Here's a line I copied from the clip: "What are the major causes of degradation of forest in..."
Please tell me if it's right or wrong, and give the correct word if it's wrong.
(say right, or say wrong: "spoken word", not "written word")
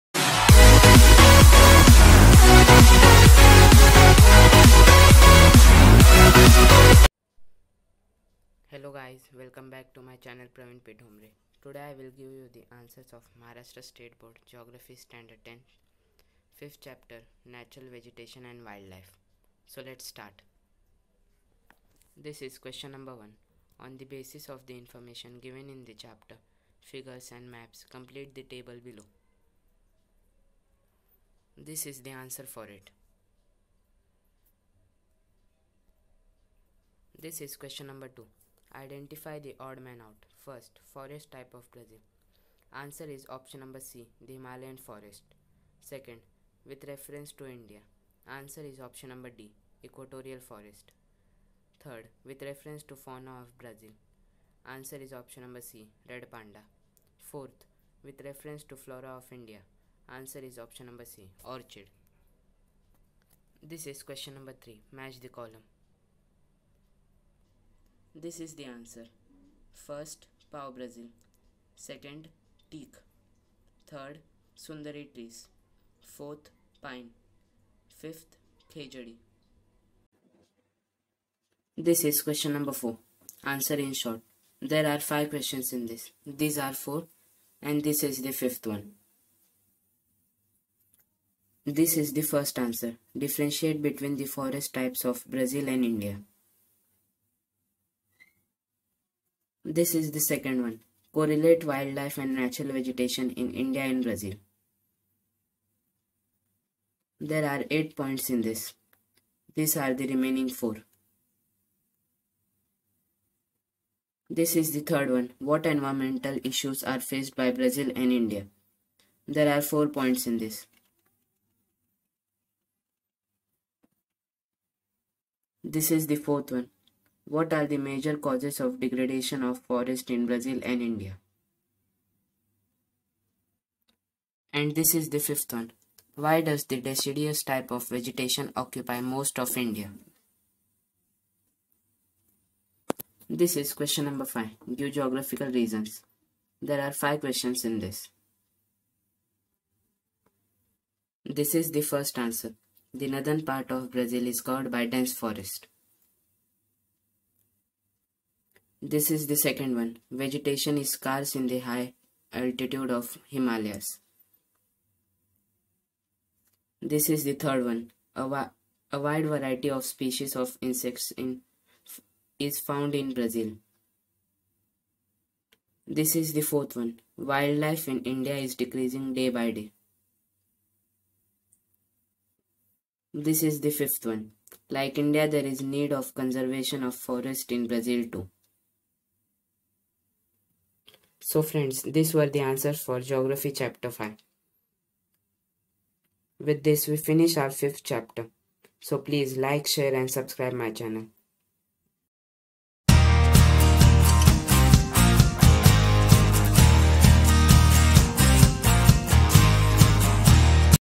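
right.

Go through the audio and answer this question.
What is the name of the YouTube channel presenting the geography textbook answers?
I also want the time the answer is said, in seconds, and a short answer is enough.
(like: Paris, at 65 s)
Praveen P Thombare, at 10 s.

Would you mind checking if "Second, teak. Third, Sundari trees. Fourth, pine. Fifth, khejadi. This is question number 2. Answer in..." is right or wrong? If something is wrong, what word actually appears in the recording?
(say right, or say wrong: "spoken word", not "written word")
wrong: "4", not "2".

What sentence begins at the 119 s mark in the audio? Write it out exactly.
There are 4 points in this.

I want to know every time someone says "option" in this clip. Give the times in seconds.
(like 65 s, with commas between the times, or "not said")
43 s, 48 s, 55 s, 60 s.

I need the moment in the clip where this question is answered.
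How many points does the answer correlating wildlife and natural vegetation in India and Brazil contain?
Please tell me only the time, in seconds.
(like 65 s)
107 s.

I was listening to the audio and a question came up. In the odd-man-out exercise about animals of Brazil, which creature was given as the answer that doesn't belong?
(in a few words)
Red panda.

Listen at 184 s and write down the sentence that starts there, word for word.
Like India, there is need of conservation of forest in Brazil too.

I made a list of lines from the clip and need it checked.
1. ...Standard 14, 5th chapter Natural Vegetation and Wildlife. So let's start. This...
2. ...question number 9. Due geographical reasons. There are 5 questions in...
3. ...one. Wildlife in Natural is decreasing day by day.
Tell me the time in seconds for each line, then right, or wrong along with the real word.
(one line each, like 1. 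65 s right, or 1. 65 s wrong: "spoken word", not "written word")
1. 14 s wrong: "10", not "14"
2. 143 s wrong: "5", not "9"
3. 176 s wrong: "India", not "Natural".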